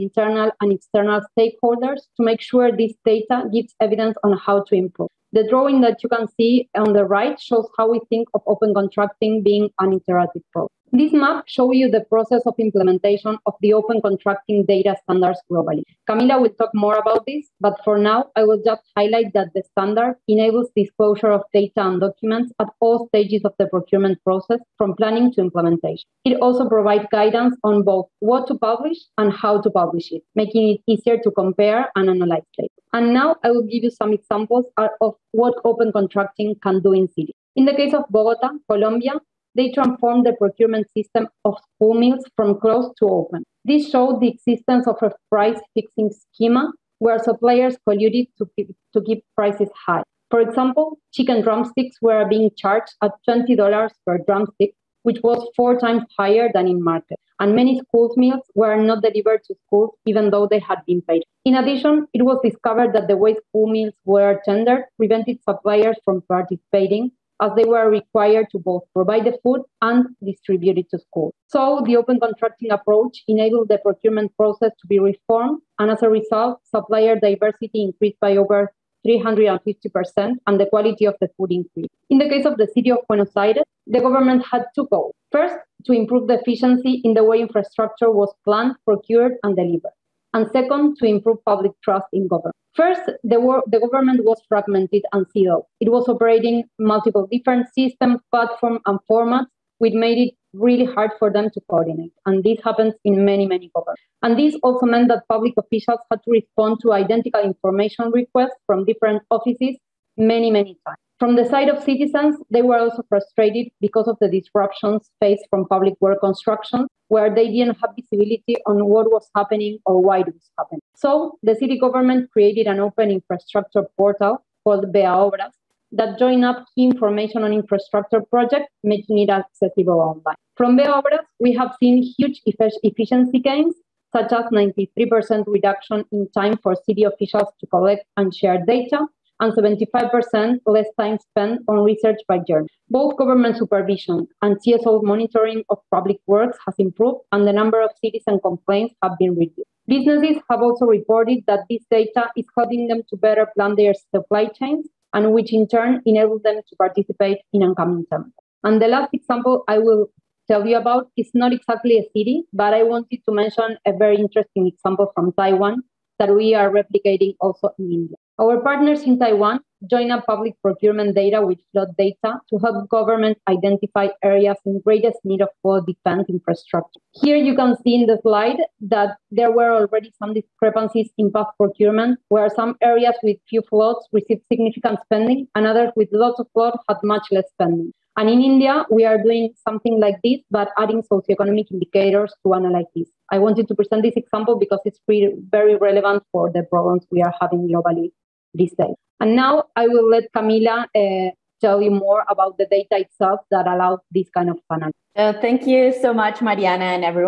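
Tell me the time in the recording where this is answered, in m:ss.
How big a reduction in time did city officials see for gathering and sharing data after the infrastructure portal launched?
2:14.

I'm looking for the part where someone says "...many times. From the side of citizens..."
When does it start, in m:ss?
1:50.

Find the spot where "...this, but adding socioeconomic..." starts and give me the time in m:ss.
3:10.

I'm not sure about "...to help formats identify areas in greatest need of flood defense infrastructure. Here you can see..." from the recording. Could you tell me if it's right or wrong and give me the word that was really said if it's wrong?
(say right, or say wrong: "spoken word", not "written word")
wrong: "governments", not "formats".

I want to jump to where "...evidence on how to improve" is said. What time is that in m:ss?
0:03.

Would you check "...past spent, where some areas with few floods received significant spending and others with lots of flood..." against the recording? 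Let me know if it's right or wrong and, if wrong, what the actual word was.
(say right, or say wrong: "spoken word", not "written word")
wrong: "procurement", not "spent".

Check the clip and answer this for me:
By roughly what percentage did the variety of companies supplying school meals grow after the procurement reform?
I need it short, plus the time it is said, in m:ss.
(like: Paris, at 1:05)
over 350%, at 1:18.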